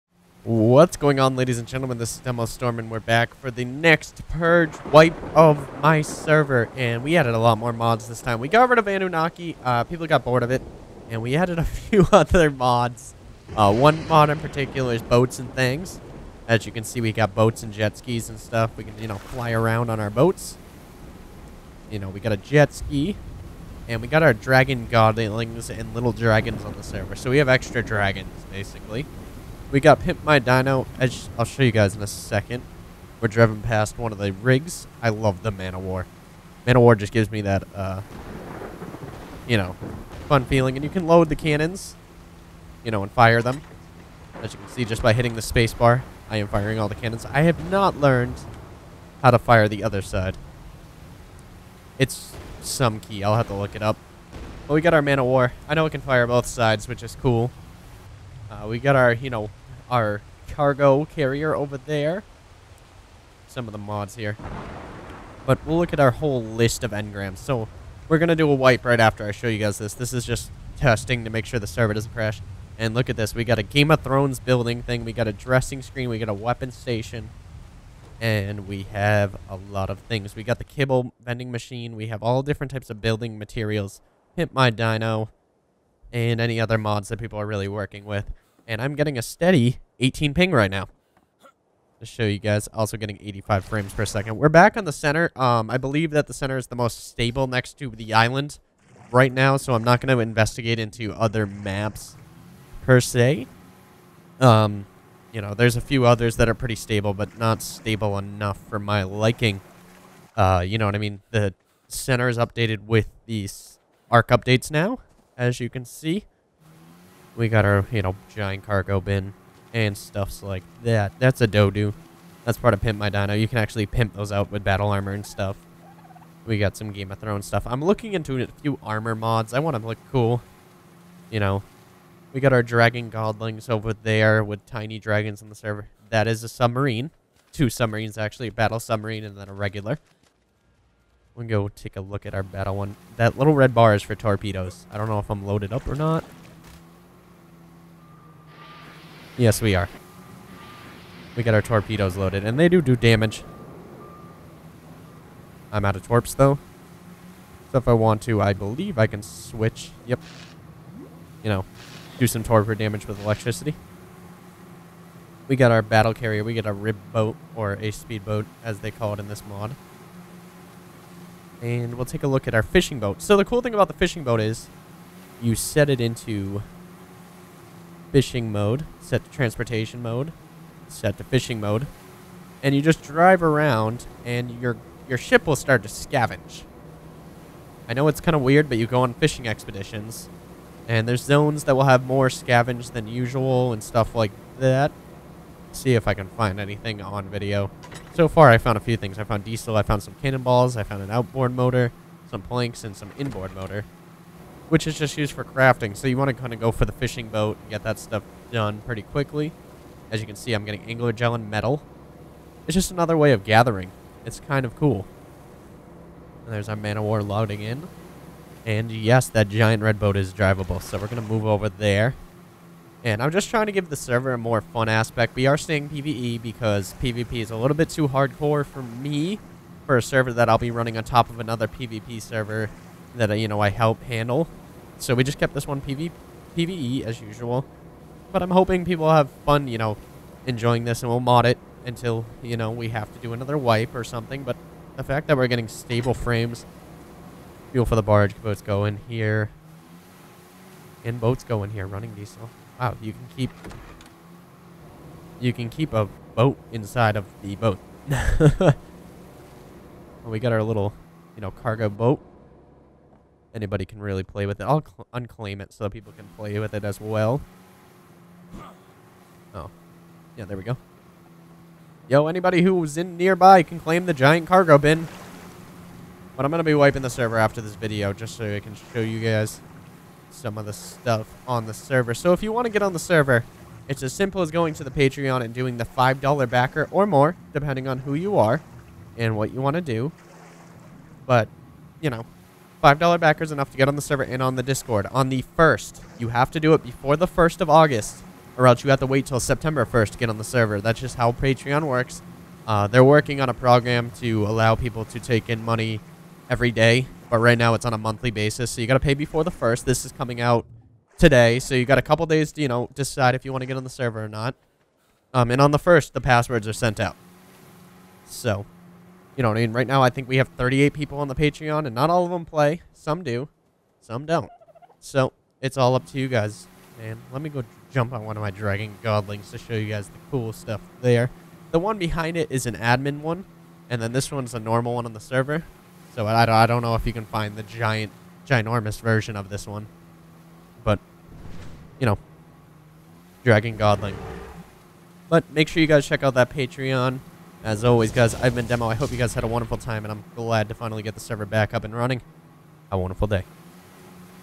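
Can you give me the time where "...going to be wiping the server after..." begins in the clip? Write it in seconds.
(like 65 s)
276 s.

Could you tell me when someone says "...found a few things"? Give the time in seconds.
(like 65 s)
198 s.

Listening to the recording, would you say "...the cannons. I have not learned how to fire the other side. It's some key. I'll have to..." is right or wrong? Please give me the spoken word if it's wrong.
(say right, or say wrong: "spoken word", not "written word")
right.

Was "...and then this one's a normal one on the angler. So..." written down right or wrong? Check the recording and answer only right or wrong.
wrong.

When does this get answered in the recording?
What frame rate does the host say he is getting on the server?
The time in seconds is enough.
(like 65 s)
93 s.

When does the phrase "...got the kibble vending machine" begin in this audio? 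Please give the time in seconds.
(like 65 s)
80 s.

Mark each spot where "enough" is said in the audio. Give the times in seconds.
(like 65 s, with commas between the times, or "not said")
108 s, 293 s.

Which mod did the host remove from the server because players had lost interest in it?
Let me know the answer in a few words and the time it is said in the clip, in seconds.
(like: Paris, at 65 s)
Anunnaki, at 8 s.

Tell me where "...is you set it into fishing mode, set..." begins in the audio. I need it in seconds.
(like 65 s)
174 s.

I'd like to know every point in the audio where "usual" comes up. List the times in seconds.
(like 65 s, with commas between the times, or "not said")
193 s, 237 s.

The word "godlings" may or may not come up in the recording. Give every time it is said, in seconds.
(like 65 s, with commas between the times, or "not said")
24 s, 133 s, 329 s, 343 s.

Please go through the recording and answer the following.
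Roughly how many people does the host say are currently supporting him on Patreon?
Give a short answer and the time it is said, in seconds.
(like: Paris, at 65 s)
38, at 320 s.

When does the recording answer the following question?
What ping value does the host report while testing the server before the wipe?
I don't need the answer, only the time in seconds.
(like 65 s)
89 s.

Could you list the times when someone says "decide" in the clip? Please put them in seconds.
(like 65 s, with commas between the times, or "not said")
312 s.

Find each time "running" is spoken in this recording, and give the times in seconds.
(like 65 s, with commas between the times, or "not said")
230 s, 251 s, 351 s.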